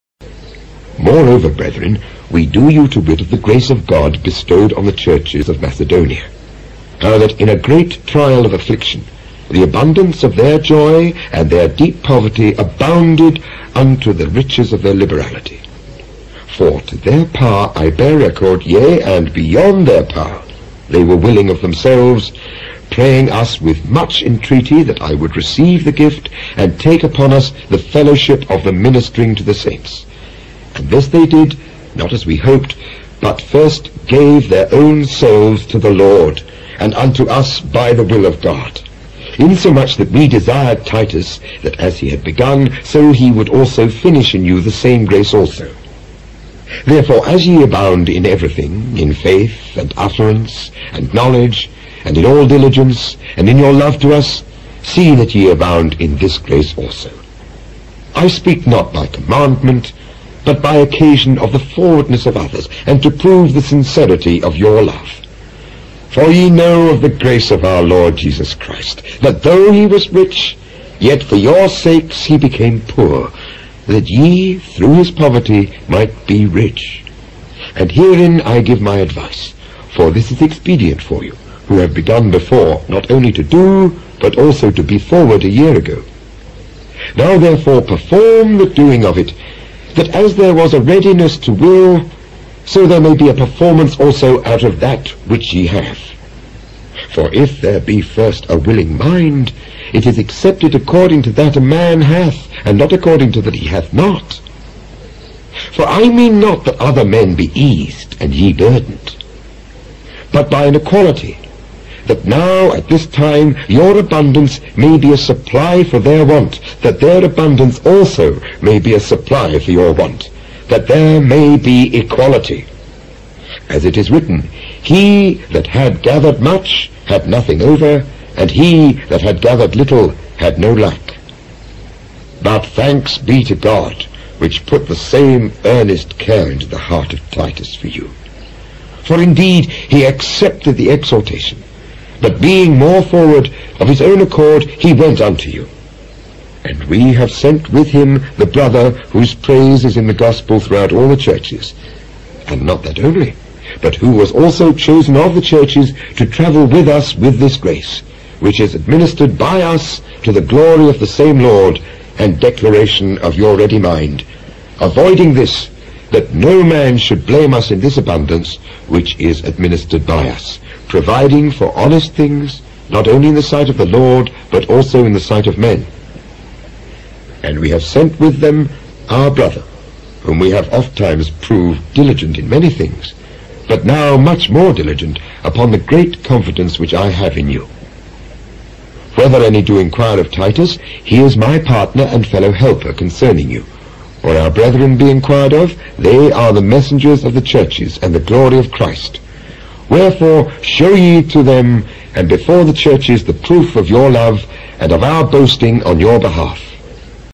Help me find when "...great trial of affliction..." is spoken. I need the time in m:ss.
0:07.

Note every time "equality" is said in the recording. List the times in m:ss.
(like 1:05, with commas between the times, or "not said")
1:50, 2:01.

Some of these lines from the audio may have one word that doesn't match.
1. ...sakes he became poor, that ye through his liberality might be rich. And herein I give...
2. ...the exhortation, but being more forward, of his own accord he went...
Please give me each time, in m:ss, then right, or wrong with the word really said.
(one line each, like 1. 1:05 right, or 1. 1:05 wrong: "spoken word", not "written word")
1. 1:11 wrong: "poverty", not "liberality"
2. 2:20 right.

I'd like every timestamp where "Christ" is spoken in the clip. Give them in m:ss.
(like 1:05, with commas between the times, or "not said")
1:08, 3:18.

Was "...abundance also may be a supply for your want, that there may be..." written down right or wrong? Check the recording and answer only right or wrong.
right.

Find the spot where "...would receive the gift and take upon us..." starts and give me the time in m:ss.
0:25.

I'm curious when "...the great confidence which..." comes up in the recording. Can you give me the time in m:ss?
3:05.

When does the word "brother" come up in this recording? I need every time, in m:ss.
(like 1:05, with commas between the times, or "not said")
2:28, 2:59.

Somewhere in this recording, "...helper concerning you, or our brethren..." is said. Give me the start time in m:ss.
3:12.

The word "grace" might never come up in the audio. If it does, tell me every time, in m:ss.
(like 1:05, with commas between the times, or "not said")
0:03, 0:45, 0:56, 1:07, 2:37.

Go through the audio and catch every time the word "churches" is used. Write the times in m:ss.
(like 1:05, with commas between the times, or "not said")
0:04, 2:31, 2:35, 3:17, 3:22.